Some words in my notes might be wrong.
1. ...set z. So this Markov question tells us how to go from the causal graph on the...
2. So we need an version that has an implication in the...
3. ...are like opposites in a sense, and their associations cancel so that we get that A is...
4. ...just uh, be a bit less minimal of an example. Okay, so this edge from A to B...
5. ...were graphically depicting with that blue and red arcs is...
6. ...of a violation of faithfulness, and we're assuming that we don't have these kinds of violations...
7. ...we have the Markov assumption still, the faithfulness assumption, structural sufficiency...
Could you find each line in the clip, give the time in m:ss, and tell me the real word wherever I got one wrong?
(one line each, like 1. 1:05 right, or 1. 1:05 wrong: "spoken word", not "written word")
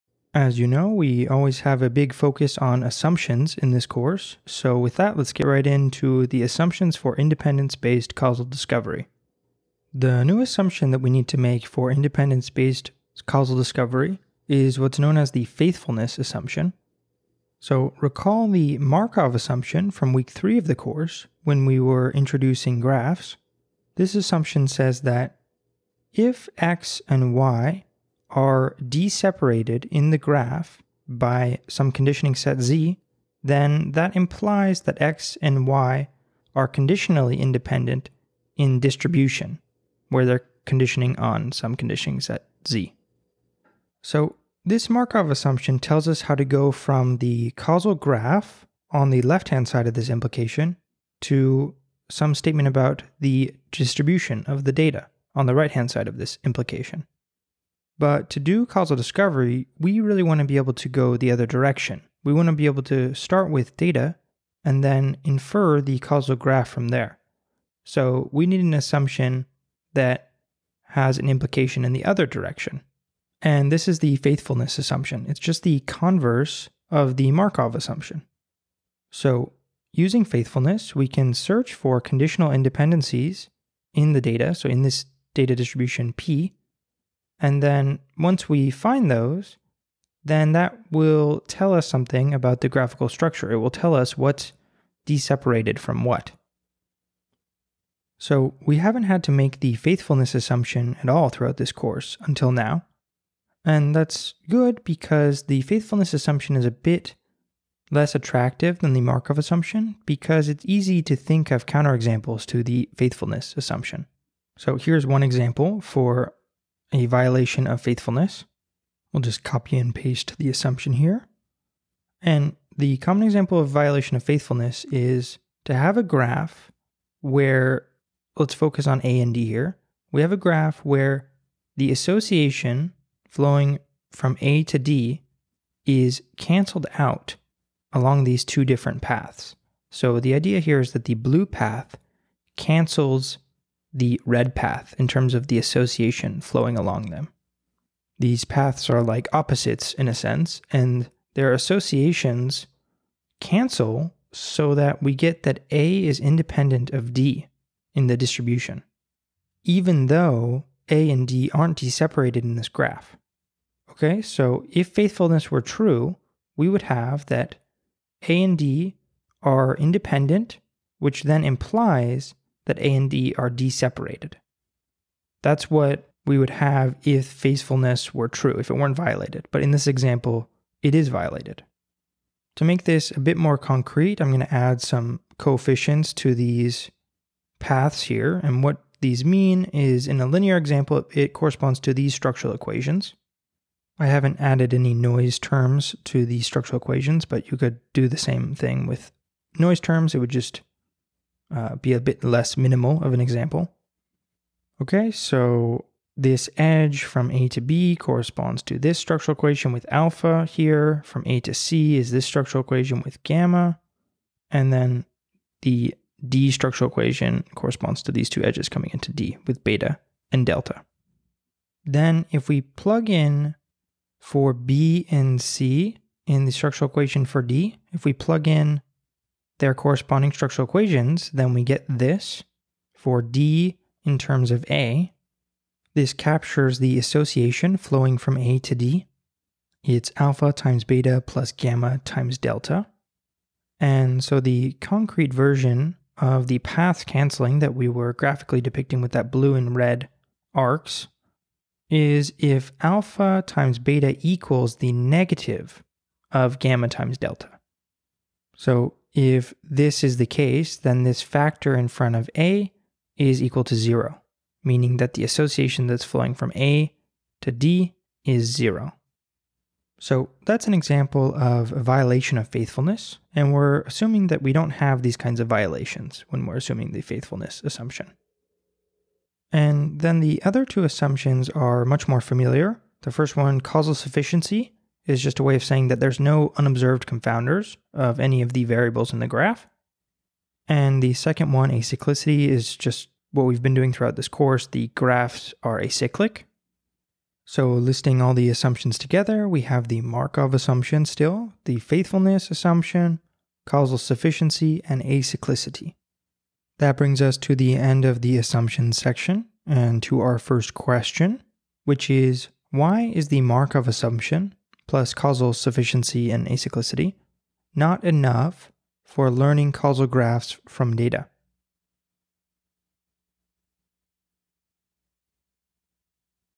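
1. 0:42 wrong: "assumption", not "question"
2. 1:07 wrong: "assumption", not "version"
3. 2:28 right
4. 3:20 right
5. 4:07 right
6. 4:31 right
7. 4:59 wrong: "causal", not "structural".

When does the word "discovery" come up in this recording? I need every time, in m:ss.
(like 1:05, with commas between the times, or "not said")
0:08, 0:13, 0:58.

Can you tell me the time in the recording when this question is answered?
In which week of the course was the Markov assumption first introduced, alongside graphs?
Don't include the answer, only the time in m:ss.
0:20.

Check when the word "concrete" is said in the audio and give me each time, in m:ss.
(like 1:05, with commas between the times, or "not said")
3:03, 4:04.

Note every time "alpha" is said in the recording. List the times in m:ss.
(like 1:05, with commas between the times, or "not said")
3:29, 4:00, 4:12.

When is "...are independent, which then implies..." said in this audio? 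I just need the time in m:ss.
2:49.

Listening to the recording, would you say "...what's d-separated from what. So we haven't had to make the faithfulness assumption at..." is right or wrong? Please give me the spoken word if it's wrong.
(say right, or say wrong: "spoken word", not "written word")
right.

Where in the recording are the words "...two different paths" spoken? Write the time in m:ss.
2:18.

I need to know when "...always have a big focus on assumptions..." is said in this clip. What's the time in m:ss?
0:01.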